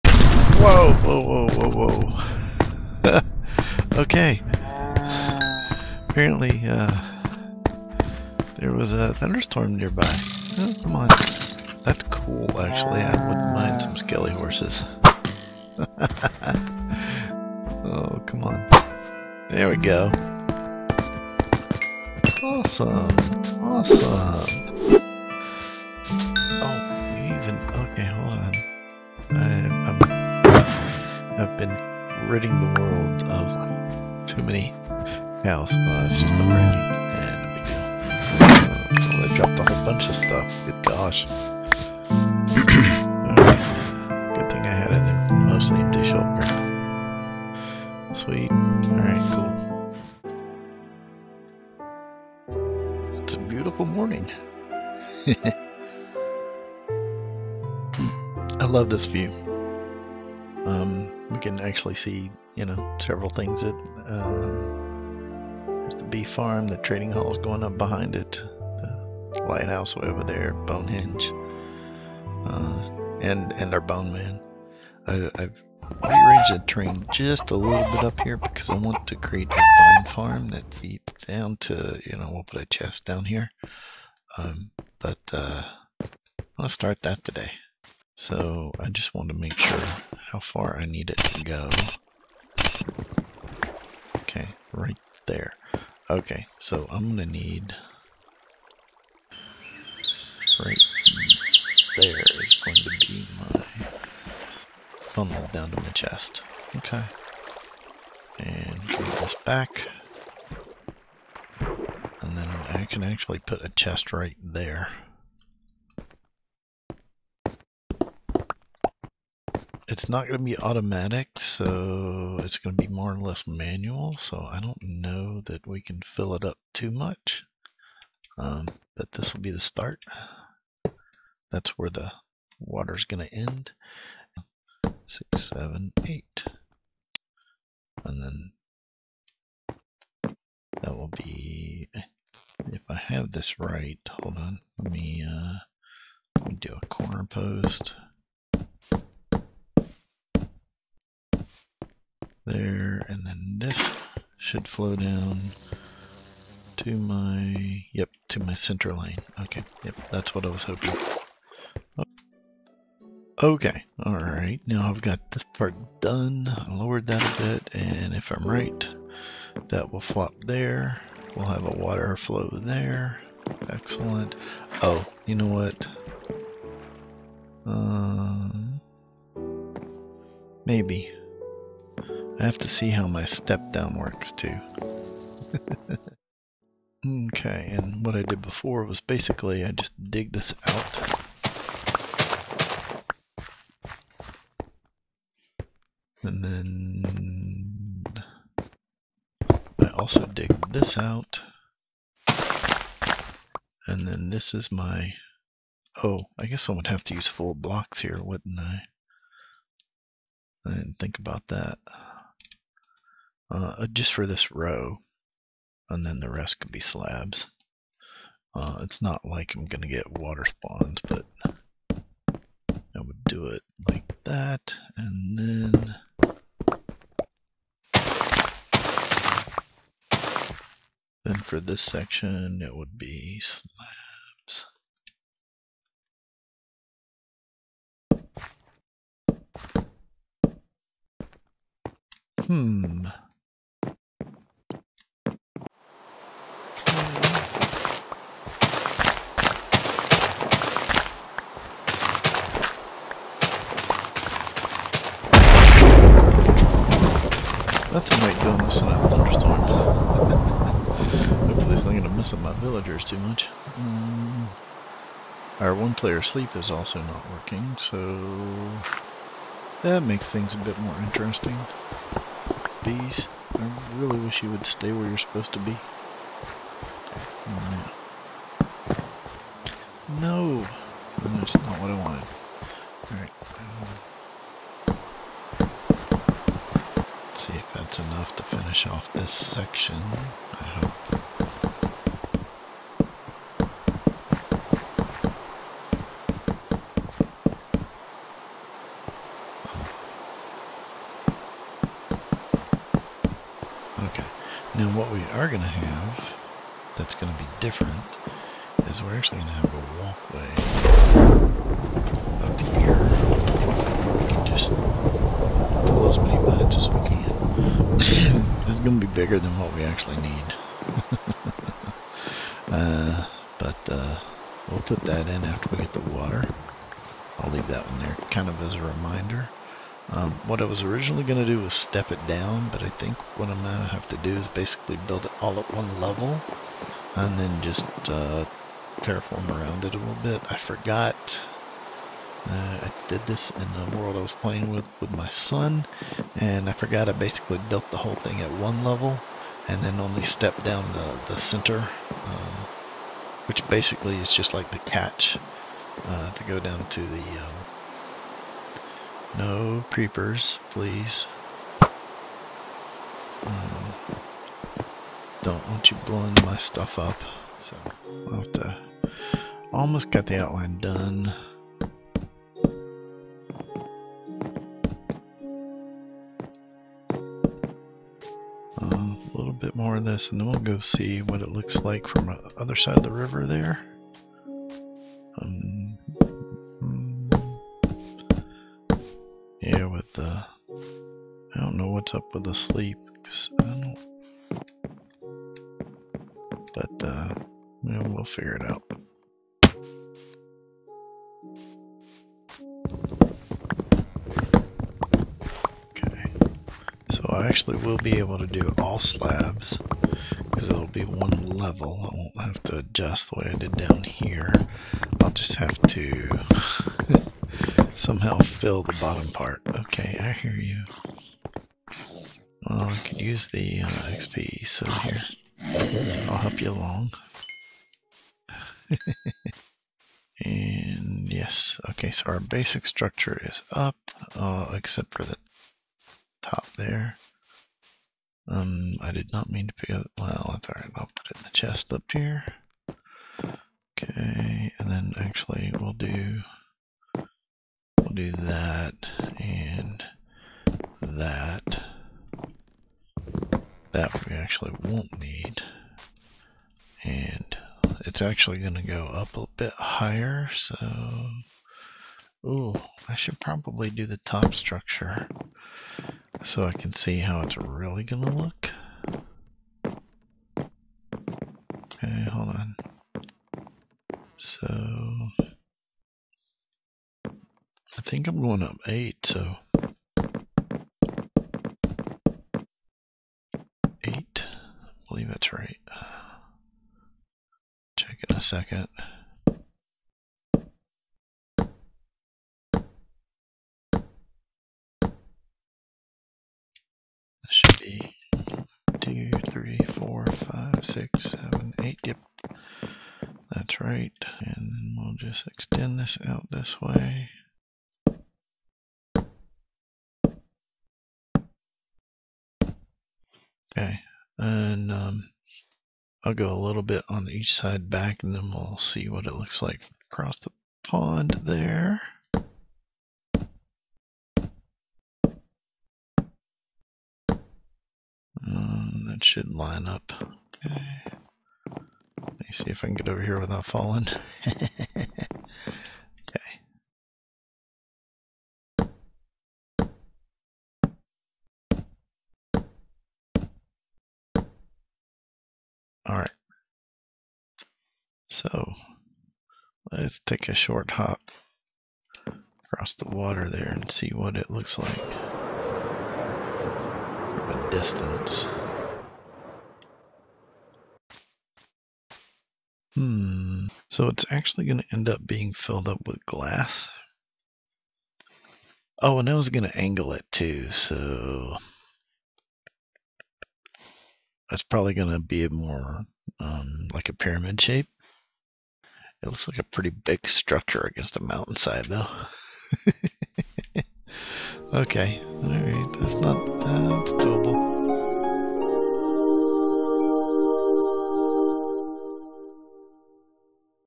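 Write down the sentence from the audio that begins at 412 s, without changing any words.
I won't have to adjust the way I did down here.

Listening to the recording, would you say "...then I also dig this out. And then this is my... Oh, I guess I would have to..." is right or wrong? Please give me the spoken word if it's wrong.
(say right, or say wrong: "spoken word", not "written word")
right.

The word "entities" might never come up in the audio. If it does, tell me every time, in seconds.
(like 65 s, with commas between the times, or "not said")
not said.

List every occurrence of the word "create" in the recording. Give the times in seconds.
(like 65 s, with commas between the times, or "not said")
79 s.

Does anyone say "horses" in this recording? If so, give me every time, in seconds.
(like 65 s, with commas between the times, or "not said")
14 s.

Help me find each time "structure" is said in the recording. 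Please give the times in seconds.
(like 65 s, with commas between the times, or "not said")
432 s, 464 s, 580 s.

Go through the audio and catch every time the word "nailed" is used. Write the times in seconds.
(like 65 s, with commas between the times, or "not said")
not said.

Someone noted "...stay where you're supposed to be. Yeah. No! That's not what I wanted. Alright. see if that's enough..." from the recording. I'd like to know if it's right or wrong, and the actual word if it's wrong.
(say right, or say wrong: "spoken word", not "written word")
right.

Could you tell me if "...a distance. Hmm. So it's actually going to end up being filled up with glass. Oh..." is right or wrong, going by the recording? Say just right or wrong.
right.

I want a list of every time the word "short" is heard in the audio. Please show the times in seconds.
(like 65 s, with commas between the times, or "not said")
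550 s.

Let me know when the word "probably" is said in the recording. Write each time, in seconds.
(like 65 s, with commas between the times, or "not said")
463 s, 574 s.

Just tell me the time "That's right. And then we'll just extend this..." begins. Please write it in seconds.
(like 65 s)
503 s.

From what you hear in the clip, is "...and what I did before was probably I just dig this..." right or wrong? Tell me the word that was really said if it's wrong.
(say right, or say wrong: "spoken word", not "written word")
wrong: "basically", not "probably".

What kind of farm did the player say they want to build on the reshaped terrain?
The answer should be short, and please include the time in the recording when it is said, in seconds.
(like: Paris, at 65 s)
Vine farm, at 79 s.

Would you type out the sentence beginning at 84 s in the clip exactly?
Um, but uh, let's start that today.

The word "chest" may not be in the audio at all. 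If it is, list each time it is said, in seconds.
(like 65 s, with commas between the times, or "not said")
82 s, 105 s, 113 s, 441 s.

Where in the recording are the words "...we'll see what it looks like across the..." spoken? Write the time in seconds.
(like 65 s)
518 s.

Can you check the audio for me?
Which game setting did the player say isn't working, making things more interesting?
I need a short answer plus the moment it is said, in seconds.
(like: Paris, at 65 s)
One-player sleep, at 265 s.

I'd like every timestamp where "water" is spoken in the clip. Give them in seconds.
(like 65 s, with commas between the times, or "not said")
132 s, 171 s, 220 s, 326 s, 553 s.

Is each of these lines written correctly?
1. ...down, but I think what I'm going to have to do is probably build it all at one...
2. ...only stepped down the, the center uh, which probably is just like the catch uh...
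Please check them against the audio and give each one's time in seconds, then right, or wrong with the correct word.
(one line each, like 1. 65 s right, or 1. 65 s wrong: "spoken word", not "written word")
1. 332 s wrong: "basically", not "probably"
2. 349 s wrong: "basically", not "probably".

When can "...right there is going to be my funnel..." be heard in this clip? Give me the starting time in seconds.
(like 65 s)
100 s.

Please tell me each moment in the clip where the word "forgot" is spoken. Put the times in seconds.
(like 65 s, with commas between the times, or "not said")
340 s, 346 s.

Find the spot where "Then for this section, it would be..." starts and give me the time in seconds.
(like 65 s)
231 s.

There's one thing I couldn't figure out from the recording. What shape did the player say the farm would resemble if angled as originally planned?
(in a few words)
Pyramid.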